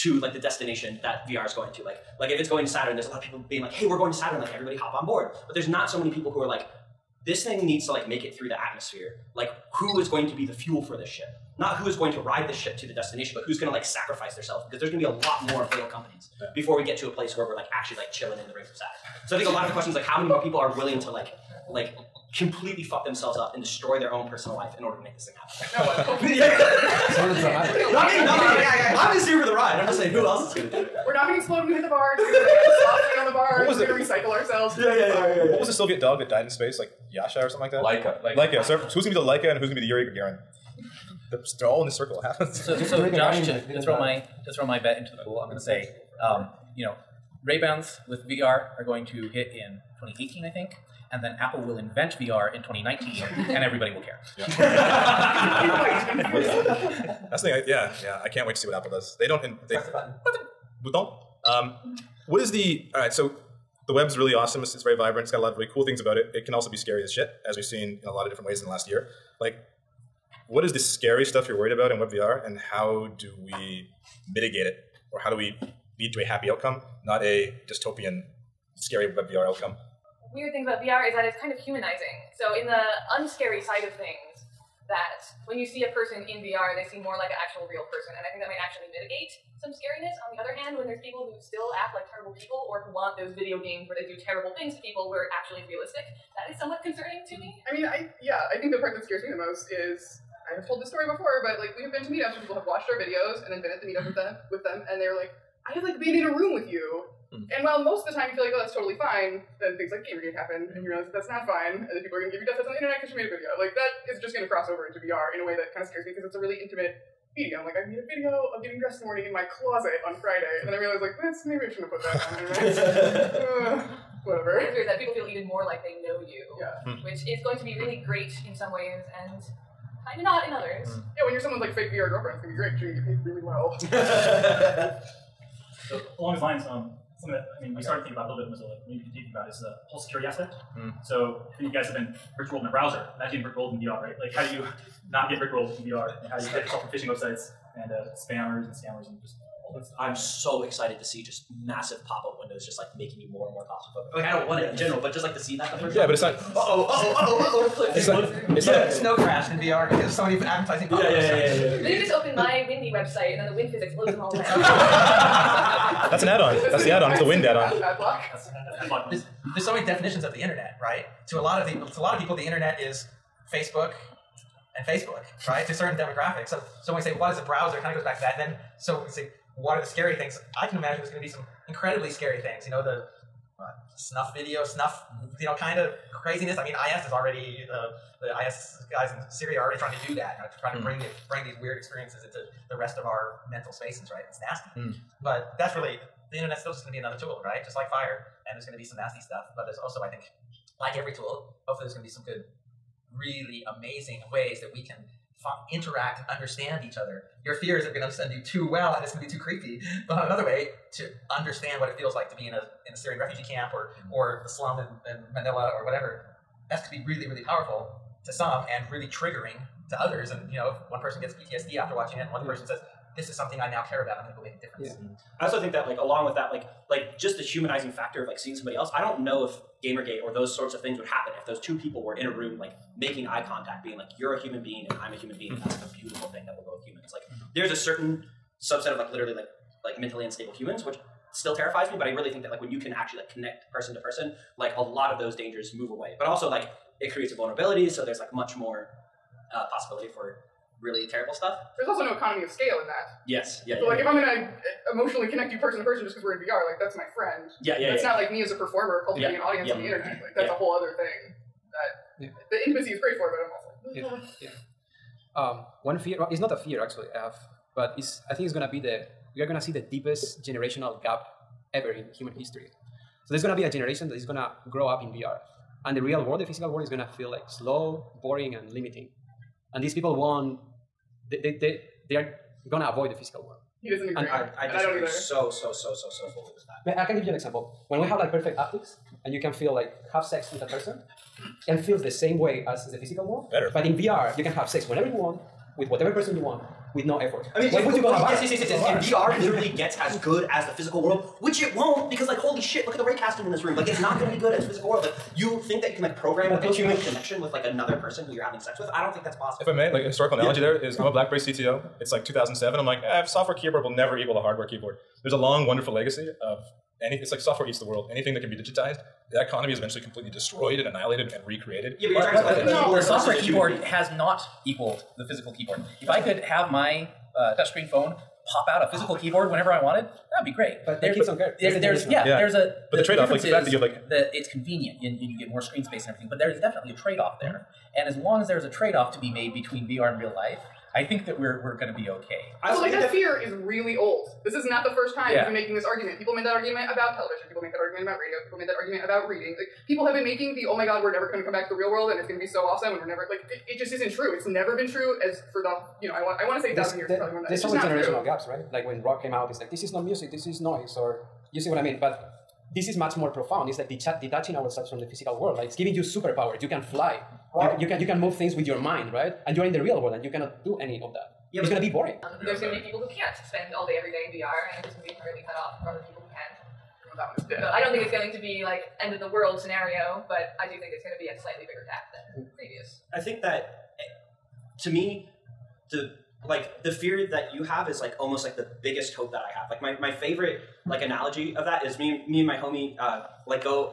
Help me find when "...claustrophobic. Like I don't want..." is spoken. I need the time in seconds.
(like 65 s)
153 s.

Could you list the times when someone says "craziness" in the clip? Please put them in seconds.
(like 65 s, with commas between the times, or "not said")
186 s.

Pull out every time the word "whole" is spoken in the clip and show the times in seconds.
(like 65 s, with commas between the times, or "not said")
139 s, 260 s.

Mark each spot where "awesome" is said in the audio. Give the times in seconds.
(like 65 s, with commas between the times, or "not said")
64 s, 352 s.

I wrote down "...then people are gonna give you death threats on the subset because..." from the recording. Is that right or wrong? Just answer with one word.
wrong.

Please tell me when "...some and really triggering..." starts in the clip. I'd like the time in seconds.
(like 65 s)
218 s.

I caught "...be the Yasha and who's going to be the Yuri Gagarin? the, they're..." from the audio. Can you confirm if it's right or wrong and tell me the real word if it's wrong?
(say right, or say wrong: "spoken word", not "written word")
wrong: "Laika", not "Yasha".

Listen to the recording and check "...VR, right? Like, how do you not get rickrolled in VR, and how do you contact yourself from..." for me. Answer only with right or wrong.
wrong.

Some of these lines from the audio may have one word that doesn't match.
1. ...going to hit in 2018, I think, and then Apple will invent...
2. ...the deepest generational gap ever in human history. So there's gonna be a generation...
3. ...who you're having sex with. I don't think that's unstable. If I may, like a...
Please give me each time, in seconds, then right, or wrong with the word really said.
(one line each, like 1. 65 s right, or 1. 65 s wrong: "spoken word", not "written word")
1. 48 s right
2. 269 s right
3. 308 s wrong: "possible", not "unstable".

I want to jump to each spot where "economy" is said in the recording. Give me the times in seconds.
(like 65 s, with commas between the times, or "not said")
252 s, 319 s.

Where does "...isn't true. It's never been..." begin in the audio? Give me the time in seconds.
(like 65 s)
353 s.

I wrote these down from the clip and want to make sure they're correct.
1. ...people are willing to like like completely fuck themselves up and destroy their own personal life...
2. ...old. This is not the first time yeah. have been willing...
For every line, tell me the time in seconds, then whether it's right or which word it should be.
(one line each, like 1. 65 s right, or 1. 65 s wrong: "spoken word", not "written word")
1. 20 s right
2. 343 s wrong: "making", not "willing".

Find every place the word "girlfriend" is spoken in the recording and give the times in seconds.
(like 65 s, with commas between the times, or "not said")
132 s.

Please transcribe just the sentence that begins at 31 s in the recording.
We're not going to explode when we hit the bar.